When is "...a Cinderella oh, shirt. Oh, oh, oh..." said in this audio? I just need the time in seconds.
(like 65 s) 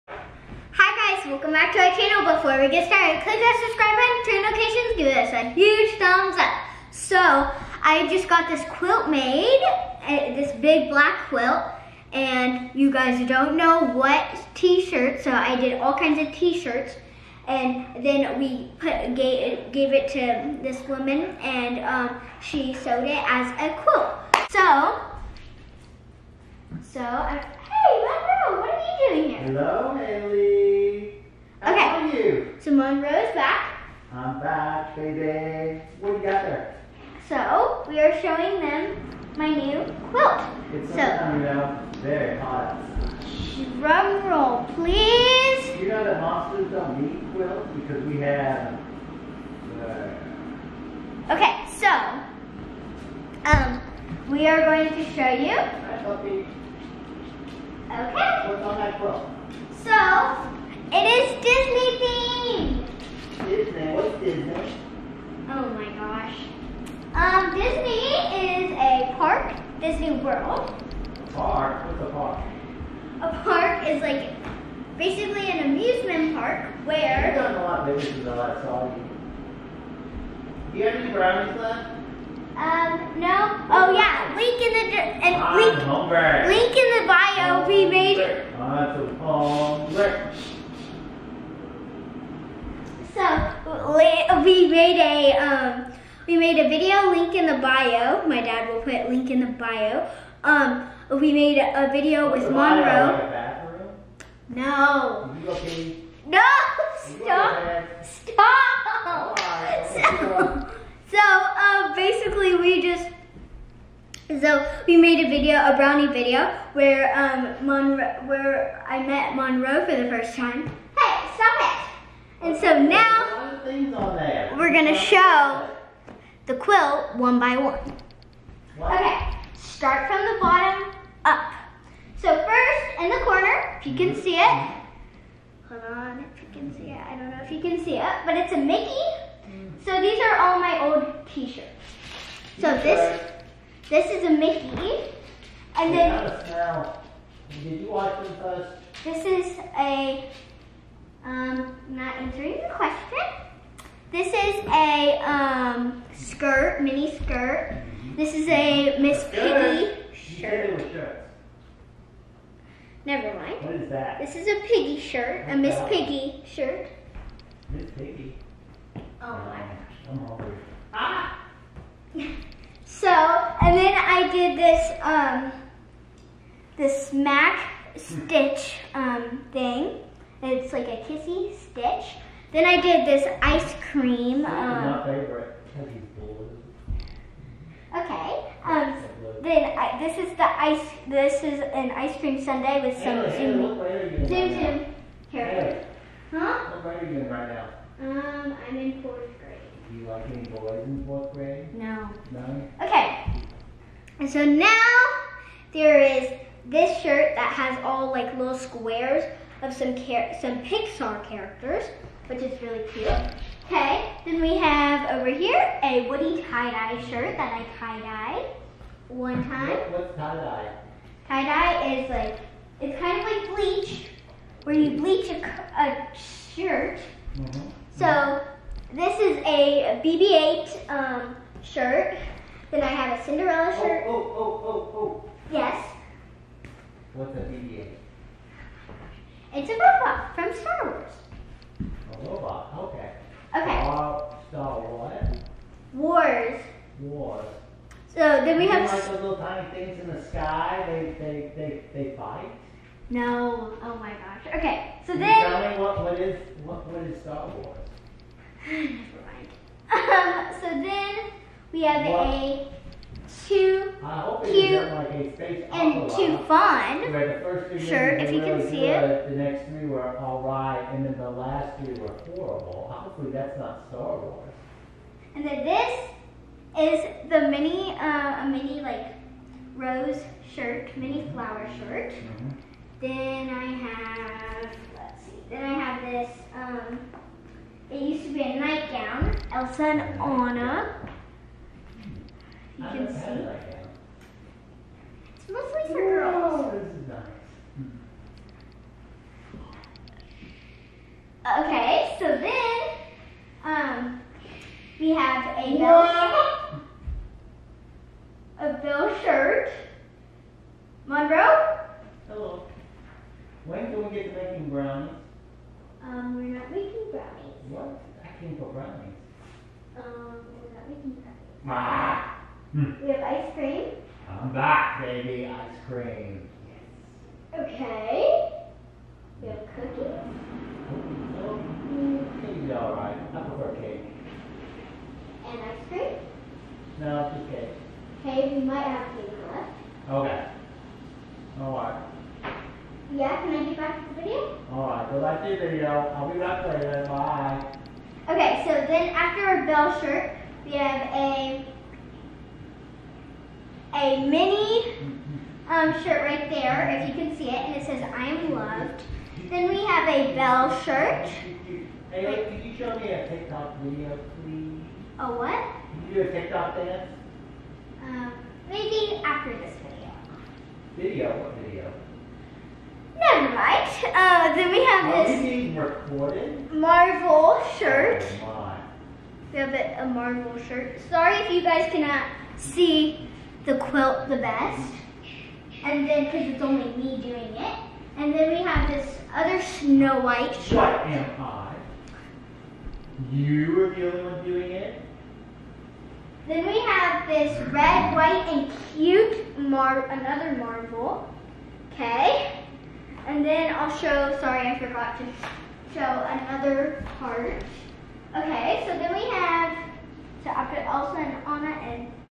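233 s.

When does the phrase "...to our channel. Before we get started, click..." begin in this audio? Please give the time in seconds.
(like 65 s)
1 s.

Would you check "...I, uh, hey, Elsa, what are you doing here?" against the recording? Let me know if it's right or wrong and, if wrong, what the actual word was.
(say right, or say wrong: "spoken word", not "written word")
wrong: "Monroe", not "Elsa".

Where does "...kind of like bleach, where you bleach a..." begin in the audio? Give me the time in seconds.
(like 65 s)
223 s.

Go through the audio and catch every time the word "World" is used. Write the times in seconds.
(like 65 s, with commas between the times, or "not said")
70 s.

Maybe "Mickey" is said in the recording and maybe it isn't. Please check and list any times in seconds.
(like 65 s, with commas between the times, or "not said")
138 s, 144 s.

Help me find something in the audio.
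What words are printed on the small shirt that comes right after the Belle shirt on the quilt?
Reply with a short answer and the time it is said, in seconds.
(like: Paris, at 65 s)
I am loved, at 358 s.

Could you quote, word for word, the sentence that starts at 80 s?
Do you have any brownies left?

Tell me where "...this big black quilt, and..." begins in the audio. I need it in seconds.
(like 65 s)
10 s.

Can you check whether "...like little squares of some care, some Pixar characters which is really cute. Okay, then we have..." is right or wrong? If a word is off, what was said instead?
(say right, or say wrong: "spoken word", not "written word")
right.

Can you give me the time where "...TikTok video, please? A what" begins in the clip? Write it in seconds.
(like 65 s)
363 s.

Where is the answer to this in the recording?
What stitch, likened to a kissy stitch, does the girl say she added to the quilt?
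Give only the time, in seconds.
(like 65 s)
177 s.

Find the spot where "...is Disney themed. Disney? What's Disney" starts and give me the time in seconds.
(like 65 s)
61 s.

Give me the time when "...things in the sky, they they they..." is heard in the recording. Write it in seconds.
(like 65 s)
249 s.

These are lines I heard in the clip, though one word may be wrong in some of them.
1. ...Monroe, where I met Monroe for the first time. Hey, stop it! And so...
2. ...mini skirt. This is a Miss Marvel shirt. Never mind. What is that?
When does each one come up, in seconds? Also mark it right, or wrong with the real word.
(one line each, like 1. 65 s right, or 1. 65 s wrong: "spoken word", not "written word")
1. 117 s right
2. 156 s wrong: "Piggy", not "Marvel".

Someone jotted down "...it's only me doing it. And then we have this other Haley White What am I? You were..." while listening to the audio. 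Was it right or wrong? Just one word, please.
wrong.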